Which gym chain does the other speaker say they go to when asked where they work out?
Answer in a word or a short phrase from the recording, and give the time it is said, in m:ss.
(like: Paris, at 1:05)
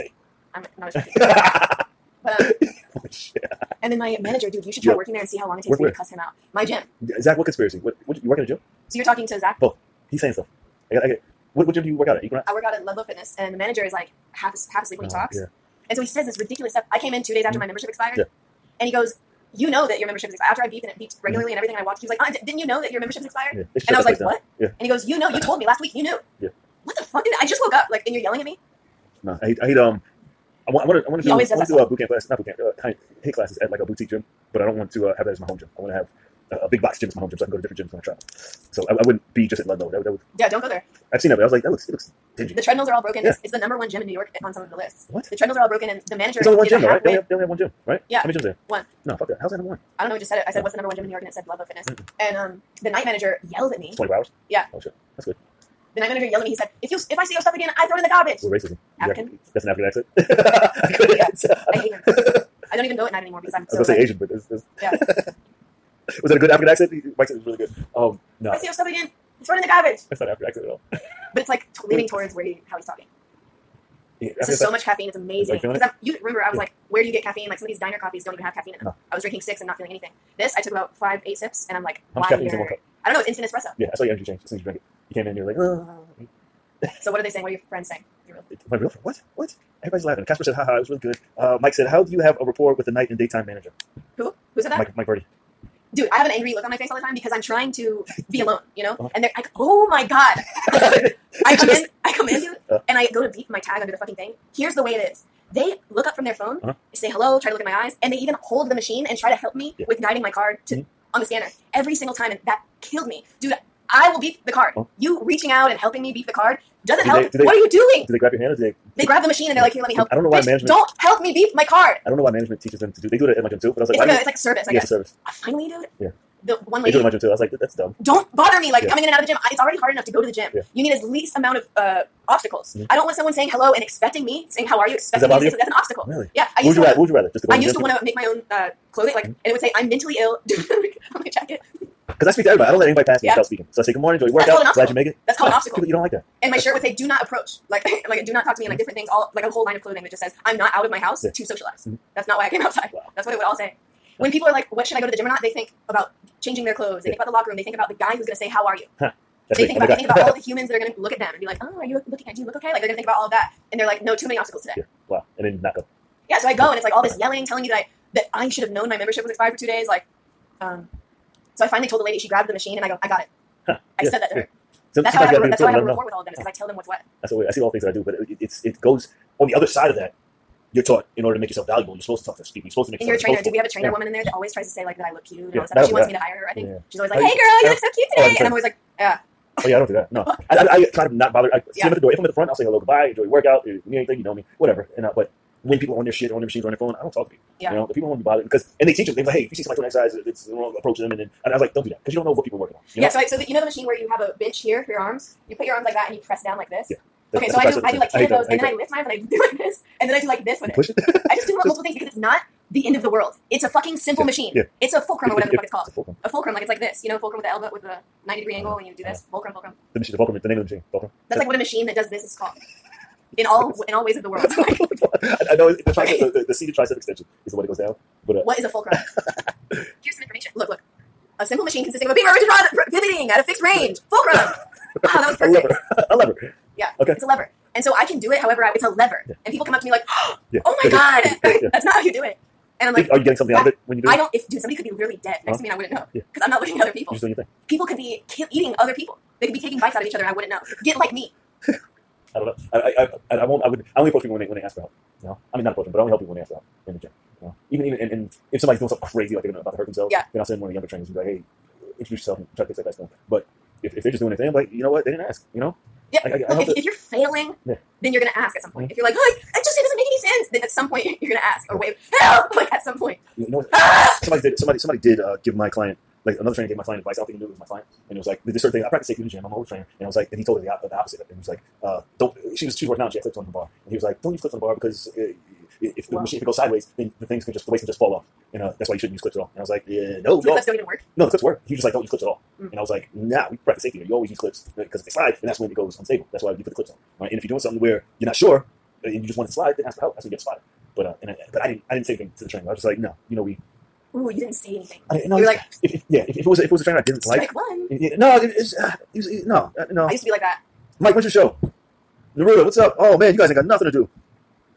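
Equinox, at 0:12.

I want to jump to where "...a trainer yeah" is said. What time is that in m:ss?
3:03.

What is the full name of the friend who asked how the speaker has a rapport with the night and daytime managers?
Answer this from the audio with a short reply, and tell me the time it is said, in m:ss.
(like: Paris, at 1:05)
Mike Verdi, at 1:34.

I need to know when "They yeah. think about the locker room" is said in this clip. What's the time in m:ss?
2:37.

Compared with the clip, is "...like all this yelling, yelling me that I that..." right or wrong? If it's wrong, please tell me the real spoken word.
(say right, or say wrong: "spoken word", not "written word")
wrong: "telling", not "yelling".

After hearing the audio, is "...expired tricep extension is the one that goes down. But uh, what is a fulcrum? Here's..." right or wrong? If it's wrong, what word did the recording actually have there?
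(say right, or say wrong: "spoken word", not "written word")
wrong: "seated", not "expired".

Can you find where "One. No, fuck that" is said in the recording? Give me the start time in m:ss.
0:48.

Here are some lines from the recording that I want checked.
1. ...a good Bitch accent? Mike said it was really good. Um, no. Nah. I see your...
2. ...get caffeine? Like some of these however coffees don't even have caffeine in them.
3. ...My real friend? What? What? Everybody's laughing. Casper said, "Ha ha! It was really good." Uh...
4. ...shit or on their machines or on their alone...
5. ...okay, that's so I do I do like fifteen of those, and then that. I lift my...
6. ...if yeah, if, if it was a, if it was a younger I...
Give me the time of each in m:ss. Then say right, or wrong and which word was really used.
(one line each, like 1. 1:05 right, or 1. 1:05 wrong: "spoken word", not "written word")
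1. 1:06 wrong: "African", not "Bitch"
2. 1:17 wrong: "diner", not "however"
3. 1:28 right
4. 3:16 wrong: "phone", not "alone"
5. 3:27 wrong: "ten", not "fifteen"
6. 5:05 wrong: "trainer", not "younger".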